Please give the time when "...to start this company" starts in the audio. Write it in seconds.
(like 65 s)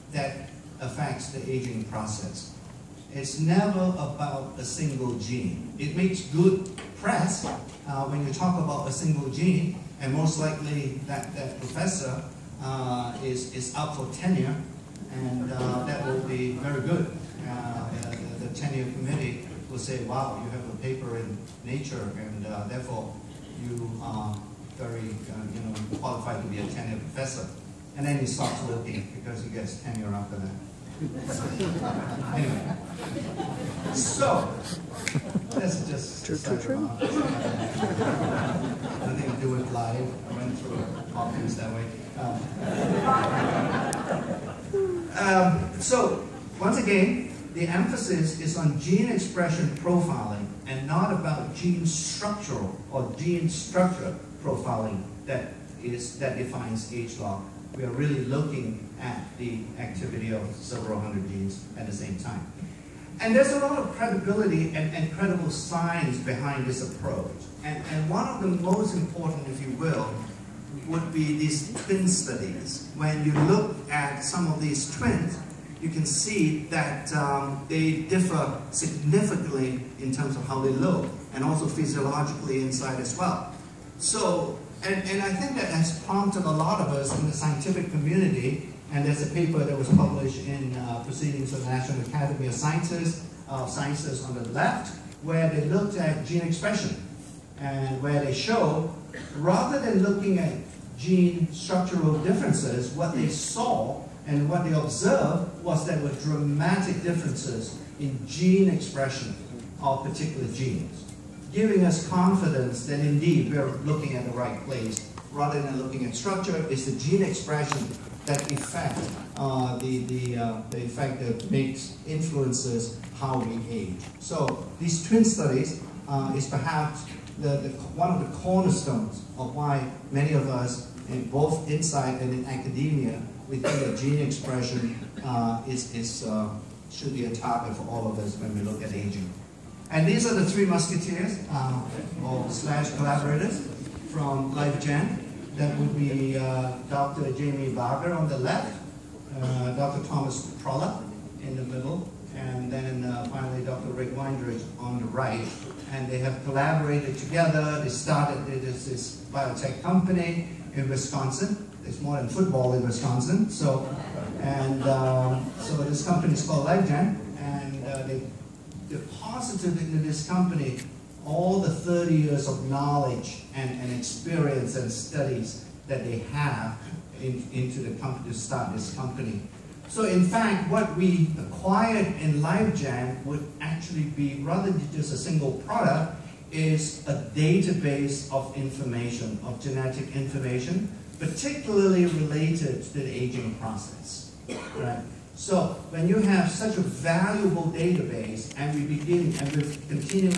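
178 s.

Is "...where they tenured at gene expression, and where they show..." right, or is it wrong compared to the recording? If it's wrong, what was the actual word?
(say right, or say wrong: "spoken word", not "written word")
wrong: "looked", not "tenured".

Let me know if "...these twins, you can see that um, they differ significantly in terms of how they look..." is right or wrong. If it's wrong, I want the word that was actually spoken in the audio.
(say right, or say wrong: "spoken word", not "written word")
right.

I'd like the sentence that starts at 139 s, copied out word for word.
And these are the three musketeers, uh, or slash collaborators from LifeGen.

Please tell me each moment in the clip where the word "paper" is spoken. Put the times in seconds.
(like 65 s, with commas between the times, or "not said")
20 s, 89 s.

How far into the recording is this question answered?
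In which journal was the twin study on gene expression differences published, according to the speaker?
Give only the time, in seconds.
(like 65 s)
91 s.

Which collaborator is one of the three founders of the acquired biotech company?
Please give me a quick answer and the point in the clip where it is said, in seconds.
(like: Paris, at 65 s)
Dr. Tomas Prolla, at 149 s.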